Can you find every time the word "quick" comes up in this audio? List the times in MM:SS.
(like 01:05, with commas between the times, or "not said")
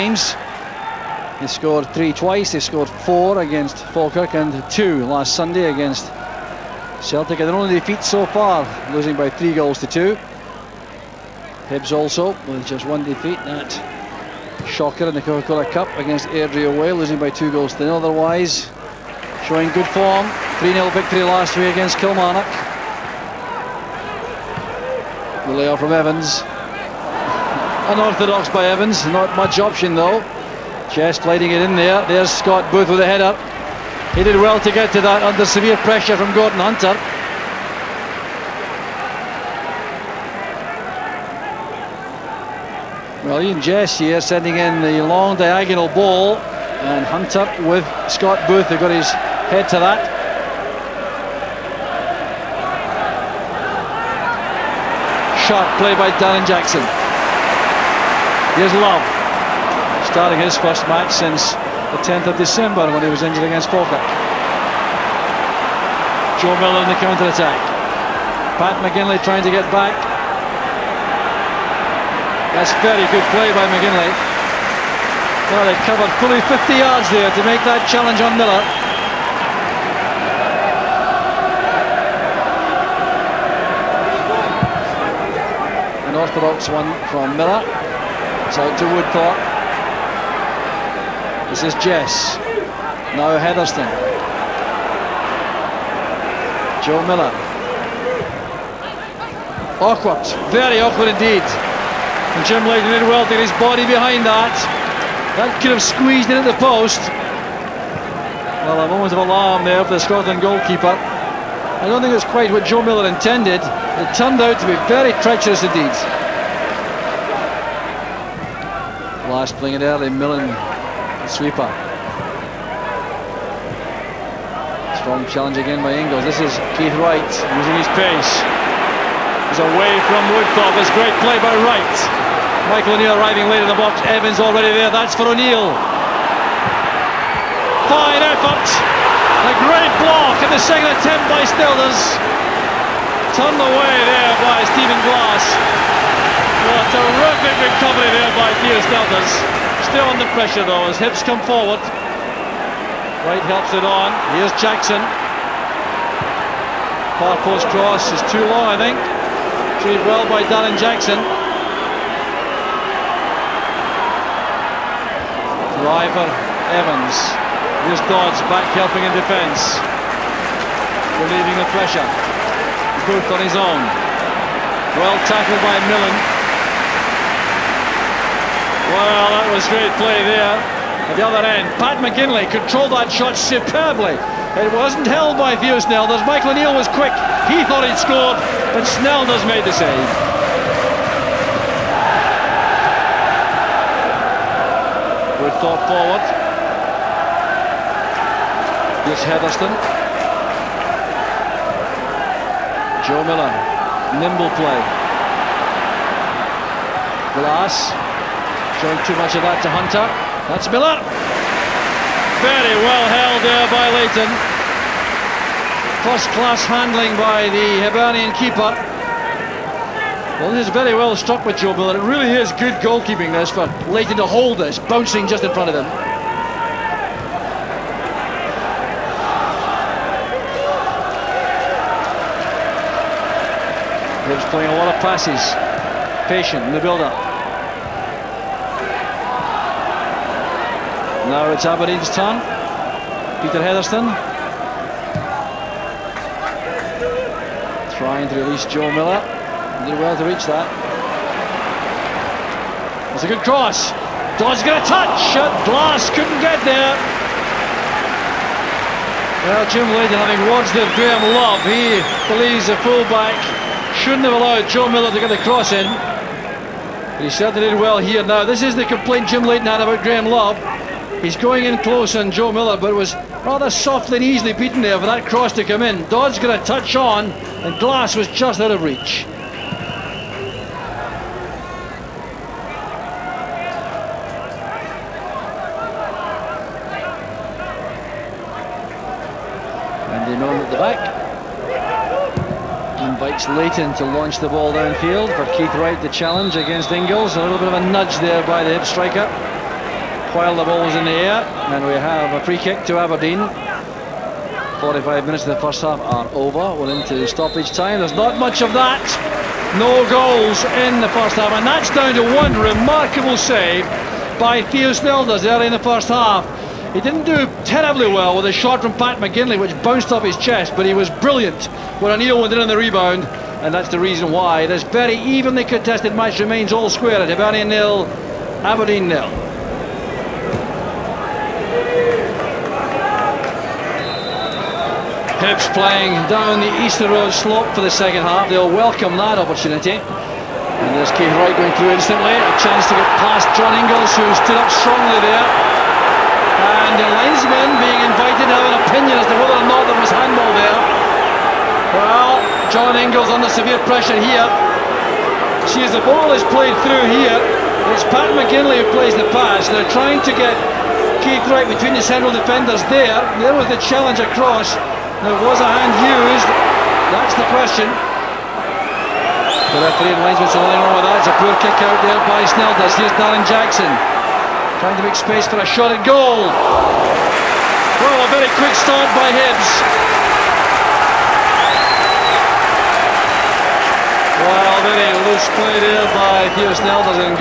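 03:06, 06:18.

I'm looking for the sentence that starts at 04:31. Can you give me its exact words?
He's going in close on Joe Miller, but it was rather softly and easily beaten there for that cross to come in.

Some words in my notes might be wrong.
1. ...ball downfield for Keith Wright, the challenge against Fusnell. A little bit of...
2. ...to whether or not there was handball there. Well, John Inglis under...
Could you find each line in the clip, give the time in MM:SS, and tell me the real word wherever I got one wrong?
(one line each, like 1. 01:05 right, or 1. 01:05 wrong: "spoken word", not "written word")
1. 04:54 wrong: "Inglis", not "Fusnell"
2. 05:49 right.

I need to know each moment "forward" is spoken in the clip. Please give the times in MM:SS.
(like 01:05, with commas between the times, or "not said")
02:31, 03:15.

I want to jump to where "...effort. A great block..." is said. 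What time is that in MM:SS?
02:18.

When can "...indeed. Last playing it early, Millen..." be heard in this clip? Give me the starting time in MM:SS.
01:55.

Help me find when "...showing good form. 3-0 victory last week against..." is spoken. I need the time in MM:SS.
00:19.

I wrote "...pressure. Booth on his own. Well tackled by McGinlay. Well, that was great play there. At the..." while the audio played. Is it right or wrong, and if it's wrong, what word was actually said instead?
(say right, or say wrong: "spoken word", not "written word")
wrong: "Millen", not "McGinlay".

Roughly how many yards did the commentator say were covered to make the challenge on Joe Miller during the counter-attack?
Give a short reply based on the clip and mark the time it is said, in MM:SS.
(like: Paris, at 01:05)
50, at 01:16.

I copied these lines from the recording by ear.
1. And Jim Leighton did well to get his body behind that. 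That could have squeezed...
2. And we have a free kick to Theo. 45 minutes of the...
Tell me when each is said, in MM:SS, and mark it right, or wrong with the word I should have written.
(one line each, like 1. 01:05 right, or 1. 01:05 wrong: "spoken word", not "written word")
1. 01:41 right
2. 05:01 wrong: "Aberdeen", not "Theo".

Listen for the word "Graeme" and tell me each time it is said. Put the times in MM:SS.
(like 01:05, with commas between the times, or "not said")
04:20, 04:30.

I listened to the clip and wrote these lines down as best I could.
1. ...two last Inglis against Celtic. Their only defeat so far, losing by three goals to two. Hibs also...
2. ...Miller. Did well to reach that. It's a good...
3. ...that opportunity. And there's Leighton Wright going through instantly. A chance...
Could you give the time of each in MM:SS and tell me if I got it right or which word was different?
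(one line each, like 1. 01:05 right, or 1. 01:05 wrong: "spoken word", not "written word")
1. 00:04 wrong: "Sunday", not "Inglis"
2. 04:08 right
3. 05:39 wrong: "Keith", not "Leighton".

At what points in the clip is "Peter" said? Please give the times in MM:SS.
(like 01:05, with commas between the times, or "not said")
02:28, 04:03.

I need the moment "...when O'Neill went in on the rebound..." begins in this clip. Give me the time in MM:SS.
05:22.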